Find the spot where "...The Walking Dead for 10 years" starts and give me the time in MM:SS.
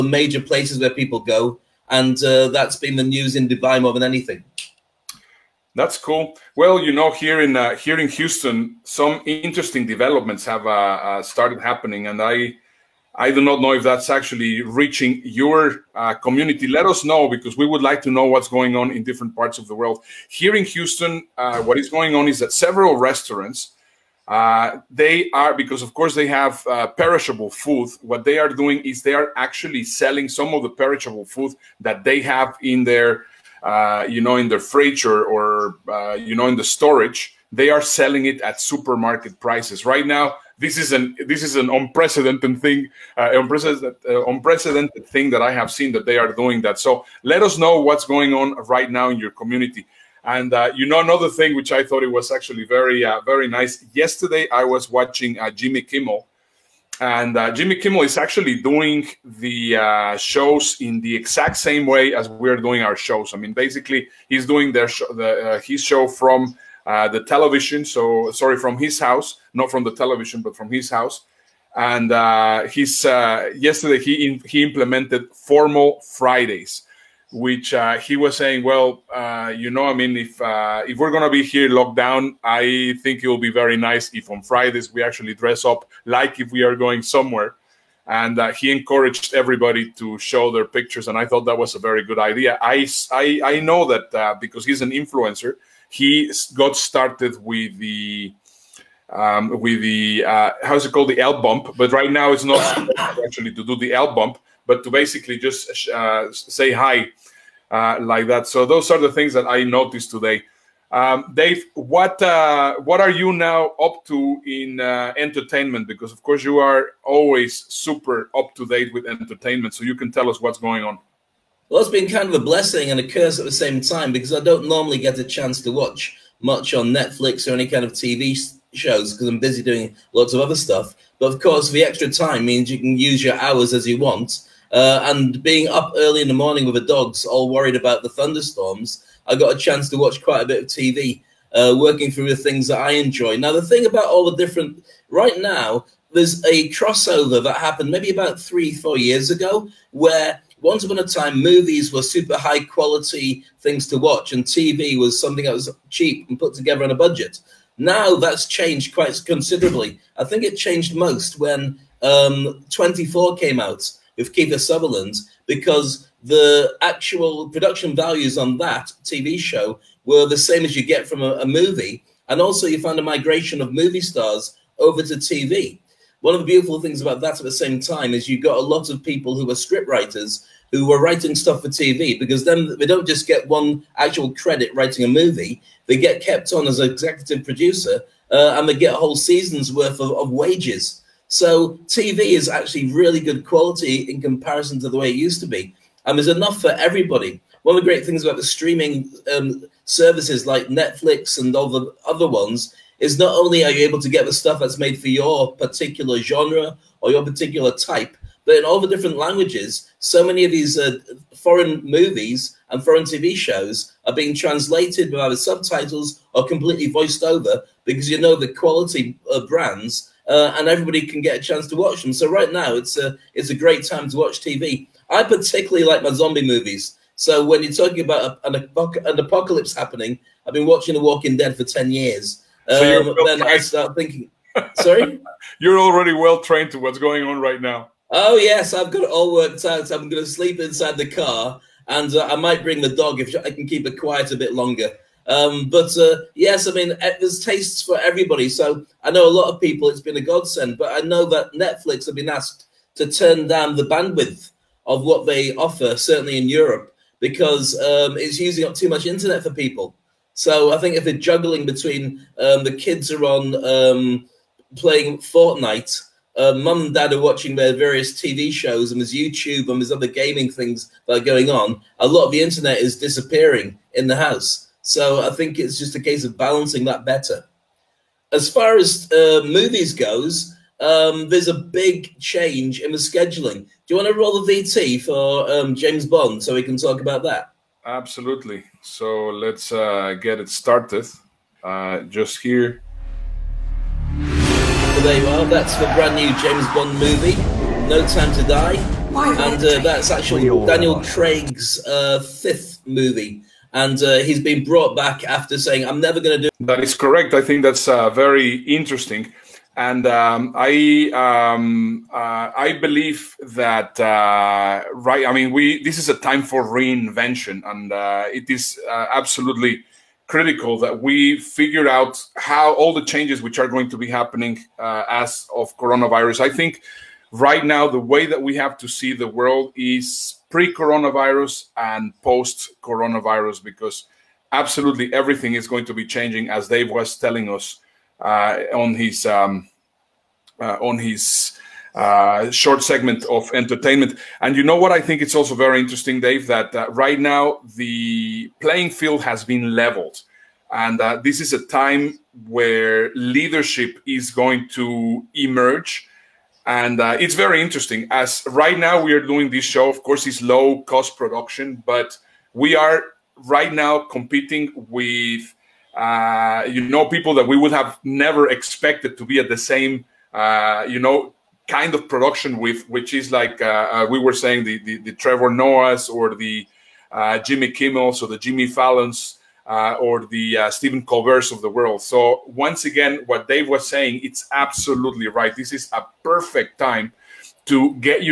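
03:50.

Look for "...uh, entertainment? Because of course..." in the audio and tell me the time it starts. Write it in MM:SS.
01:54.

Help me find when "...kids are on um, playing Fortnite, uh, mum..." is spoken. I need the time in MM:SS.
04:22.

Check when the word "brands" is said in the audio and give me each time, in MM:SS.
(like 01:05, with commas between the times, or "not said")
03:39, 04:55.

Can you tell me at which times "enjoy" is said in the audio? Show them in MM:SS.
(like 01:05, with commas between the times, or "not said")
02:22.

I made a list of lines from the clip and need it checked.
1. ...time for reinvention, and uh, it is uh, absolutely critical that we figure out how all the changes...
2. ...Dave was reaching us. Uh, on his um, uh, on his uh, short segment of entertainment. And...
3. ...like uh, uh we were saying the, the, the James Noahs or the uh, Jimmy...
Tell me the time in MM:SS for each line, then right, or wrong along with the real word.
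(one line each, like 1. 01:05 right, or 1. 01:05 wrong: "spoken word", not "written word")
1. 05:16 right
2. 05:36 wrong: "telling", not "reaching"
3. 06:13 wrong: "Trevor", not "James".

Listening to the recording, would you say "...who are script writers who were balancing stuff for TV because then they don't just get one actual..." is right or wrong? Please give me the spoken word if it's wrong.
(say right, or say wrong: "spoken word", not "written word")
wrong: "writing", not "balancing".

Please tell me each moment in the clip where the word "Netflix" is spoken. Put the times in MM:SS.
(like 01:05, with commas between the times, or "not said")
02:06, 03:20, 04:11.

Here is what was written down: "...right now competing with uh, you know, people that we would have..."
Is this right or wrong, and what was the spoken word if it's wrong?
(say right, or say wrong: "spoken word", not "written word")
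right.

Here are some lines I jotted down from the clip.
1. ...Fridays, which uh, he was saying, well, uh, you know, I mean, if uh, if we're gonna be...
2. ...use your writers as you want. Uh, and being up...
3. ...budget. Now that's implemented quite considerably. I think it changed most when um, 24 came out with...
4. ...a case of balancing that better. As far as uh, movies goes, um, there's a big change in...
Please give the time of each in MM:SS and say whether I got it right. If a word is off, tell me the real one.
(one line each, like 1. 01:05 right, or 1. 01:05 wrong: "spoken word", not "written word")
1. 01:16 right
2. 02:12 wrong: "hours", not "writers"
3. 02:36 wrong: "changed", not "implemented"
4. 04:35 right.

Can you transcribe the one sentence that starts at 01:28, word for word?
And he encouraged everybody to show their pictures, and I thought that was a very good idea.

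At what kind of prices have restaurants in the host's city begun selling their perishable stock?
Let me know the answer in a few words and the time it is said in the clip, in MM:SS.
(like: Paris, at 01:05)
Supermarket prices, at 00:38.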